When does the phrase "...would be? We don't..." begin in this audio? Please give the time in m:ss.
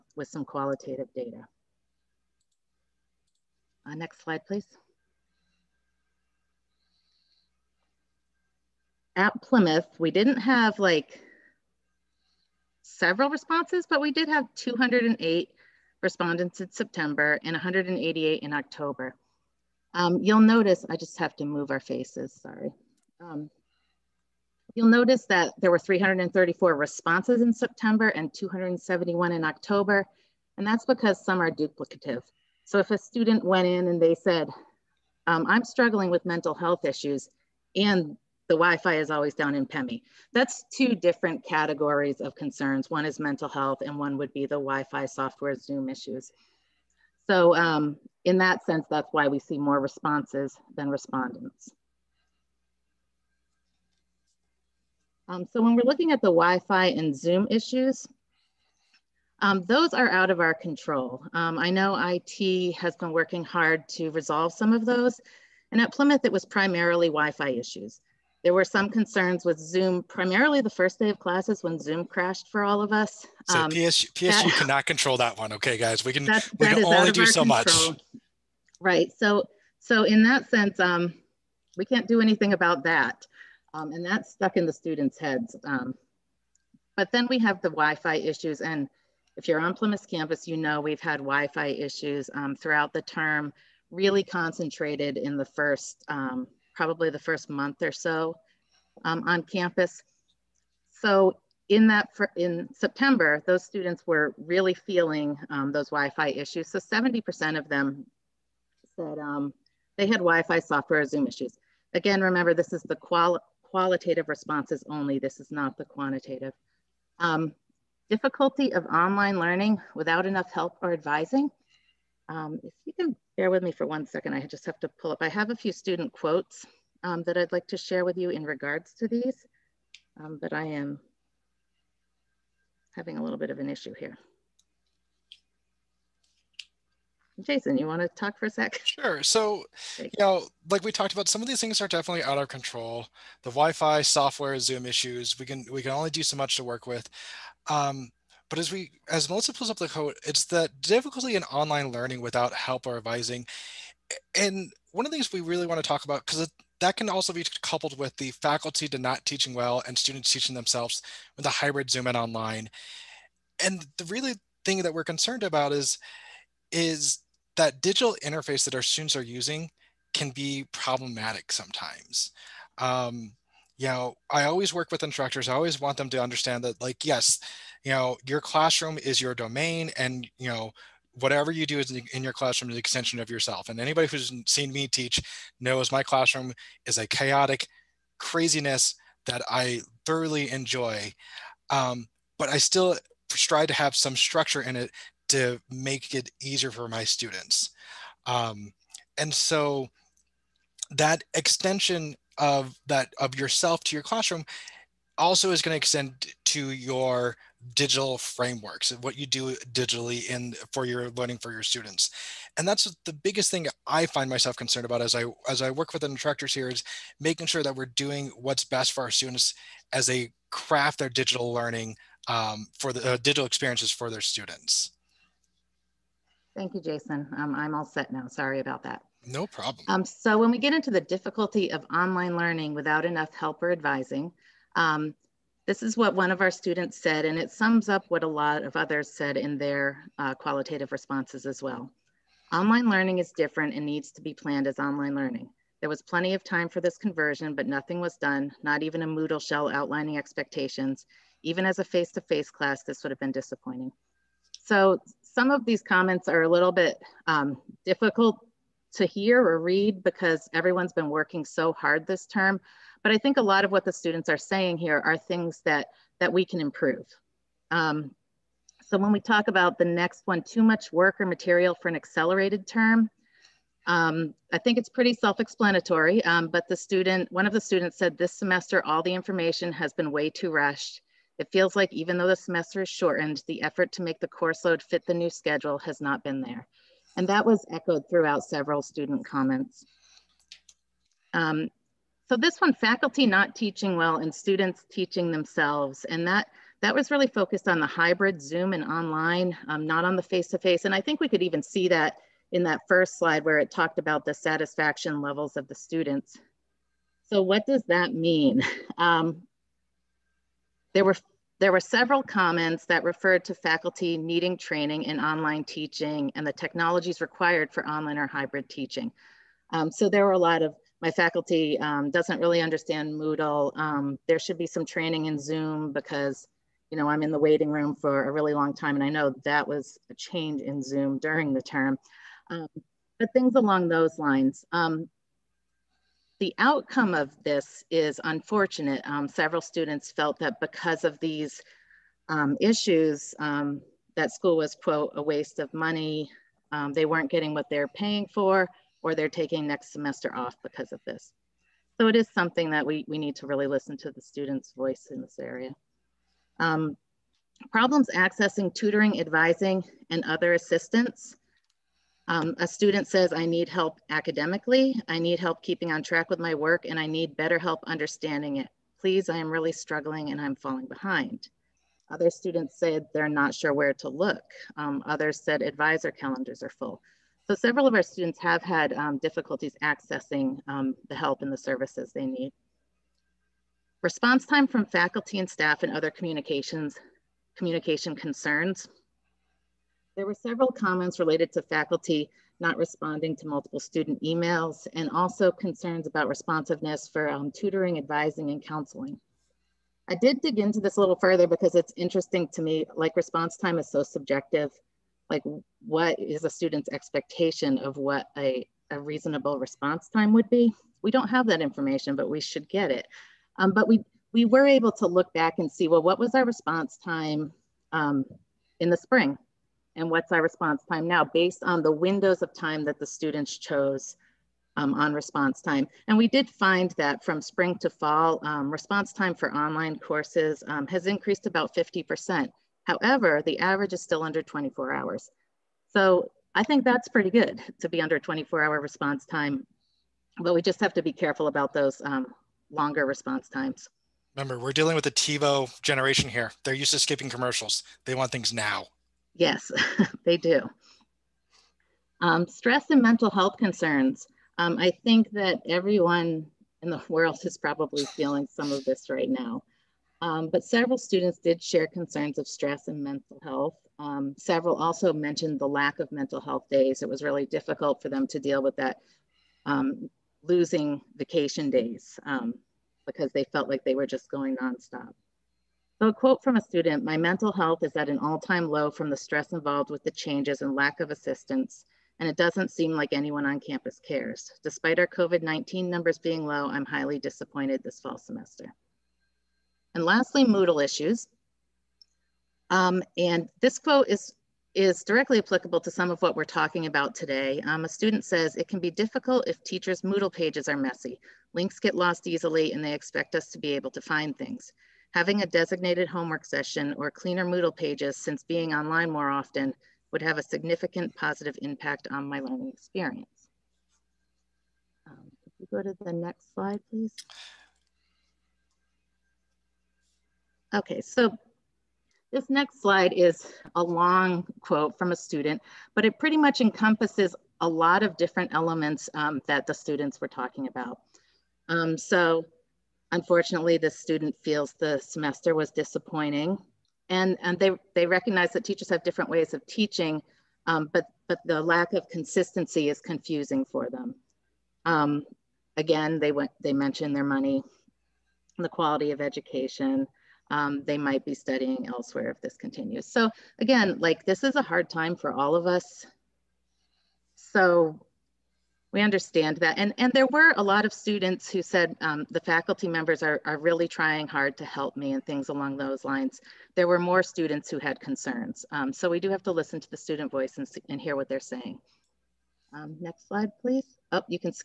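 6:50.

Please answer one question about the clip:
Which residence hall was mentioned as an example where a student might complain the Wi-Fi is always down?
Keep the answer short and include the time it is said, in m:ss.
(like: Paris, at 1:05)
PEMI, at 0:39.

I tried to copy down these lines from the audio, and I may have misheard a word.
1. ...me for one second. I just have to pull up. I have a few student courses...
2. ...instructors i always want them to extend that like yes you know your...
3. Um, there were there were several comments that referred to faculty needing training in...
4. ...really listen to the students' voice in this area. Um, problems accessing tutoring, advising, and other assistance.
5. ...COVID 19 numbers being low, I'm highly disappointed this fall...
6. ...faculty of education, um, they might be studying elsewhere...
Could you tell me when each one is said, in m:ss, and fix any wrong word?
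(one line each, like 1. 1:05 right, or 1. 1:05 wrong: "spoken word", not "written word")
1. 2:03 wrong: "quotes", not "courses"
2. 2:55 wrong: "understand", not "extend"
3. 5:08 right
4. 5:53 right
5. 8:05 right
6. 9:08 wrong: "quality", not "faculty".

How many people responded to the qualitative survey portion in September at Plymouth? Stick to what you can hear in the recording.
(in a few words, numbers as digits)
208.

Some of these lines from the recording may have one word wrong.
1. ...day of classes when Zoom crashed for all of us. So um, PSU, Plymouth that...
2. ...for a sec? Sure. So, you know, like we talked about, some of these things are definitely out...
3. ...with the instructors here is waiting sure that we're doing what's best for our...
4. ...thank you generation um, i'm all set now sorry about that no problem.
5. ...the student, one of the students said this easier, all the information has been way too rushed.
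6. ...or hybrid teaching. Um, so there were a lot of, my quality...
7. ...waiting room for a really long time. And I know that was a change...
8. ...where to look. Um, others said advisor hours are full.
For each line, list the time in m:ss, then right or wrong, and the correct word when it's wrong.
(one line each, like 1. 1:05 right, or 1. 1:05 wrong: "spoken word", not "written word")
1. 1:10 wrong: "PSU", not "Plymouth"
2. 2:18 right
3. 3:35 wrong: "making", not "waiting"
4. 3:46 wrong: "jason", not "generation"
5. 4:36 wrong: "semester", not "easier"
6. 5:18 wrong: "faculty", not "quality"
7. 5:27 right
8. 6:13 wrong: "calendars", not "hours".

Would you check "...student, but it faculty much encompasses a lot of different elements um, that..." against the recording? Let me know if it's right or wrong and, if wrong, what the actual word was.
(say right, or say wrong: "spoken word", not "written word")
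wrong: "pretty", not "faculty".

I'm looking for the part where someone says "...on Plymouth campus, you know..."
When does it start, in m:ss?
1:29.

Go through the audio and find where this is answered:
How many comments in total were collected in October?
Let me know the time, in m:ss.
0:28.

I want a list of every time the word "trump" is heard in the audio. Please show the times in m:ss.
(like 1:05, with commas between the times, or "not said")
not said.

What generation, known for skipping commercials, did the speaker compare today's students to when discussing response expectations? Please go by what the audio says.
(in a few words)
TiVo generation.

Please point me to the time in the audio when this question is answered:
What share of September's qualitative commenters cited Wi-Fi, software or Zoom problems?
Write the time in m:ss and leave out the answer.
1:46.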